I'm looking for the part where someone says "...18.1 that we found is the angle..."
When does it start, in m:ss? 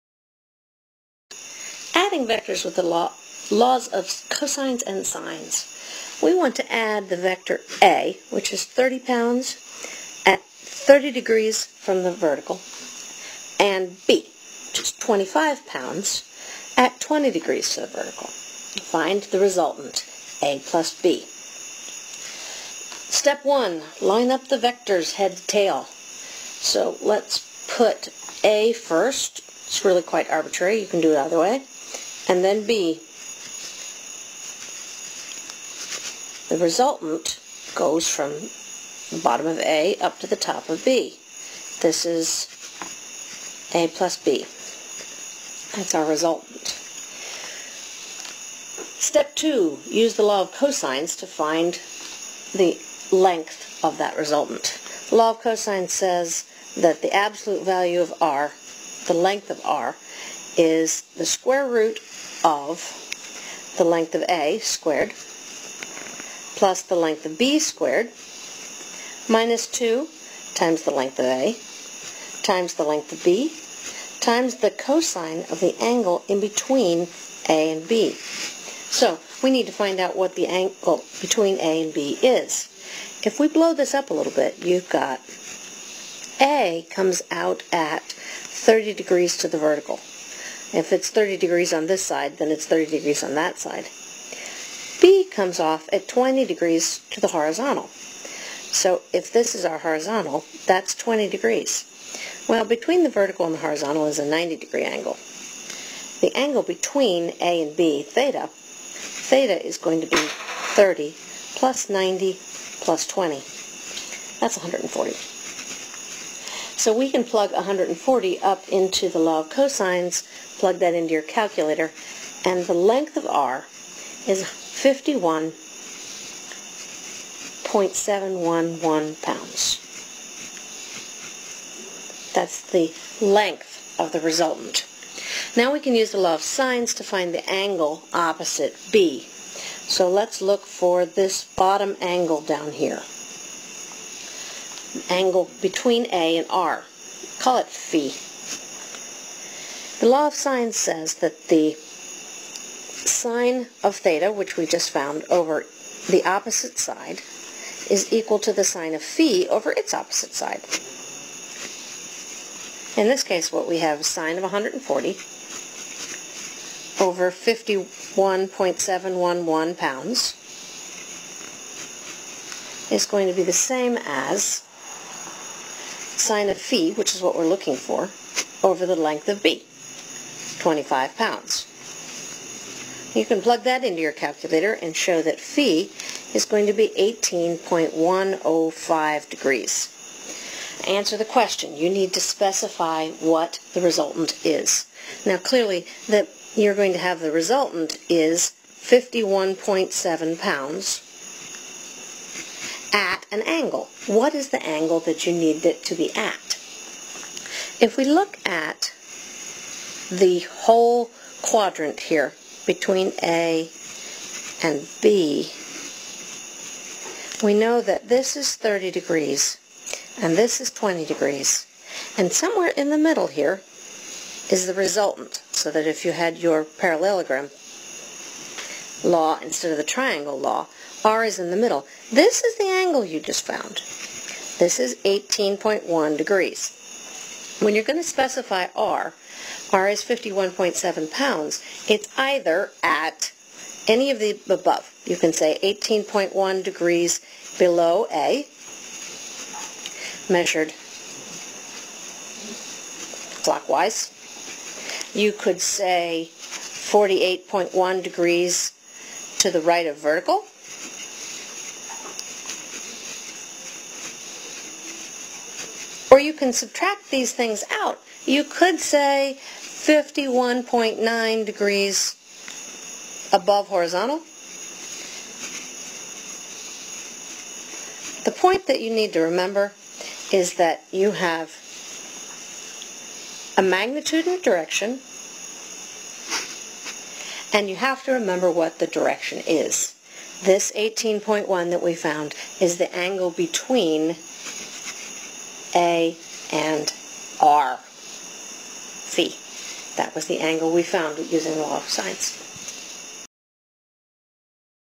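4:50.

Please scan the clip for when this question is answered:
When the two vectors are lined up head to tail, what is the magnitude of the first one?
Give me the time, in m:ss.
0:08.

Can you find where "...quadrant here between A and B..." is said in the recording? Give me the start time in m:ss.
3:31.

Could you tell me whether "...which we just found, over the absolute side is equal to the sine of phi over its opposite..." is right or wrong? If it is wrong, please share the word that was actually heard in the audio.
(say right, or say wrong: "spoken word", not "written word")
wrong: "opposite", not "absolute".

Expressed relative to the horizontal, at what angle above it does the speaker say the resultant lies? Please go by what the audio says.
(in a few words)
51.9 degrees.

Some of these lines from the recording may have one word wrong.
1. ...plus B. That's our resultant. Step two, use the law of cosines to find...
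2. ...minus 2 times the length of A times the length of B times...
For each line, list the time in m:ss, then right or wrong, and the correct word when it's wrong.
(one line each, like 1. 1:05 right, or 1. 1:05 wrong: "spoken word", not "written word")
1. 0:43 right
2. 1:09 right.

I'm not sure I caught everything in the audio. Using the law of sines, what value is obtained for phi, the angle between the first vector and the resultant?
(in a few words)
18.105 degrees.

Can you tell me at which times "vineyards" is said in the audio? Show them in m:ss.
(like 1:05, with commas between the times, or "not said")
not said.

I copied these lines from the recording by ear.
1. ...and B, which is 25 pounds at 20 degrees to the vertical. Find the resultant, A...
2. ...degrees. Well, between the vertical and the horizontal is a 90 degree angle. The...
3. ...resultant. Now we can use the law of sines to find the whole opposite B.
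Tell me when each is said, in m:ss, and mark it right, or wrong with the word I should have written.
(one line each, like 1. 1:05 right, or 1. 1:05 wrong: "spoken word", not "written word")
1. 0:13 right
2. 1:41 right
3. 2:14 wrong: "angle", not "whole".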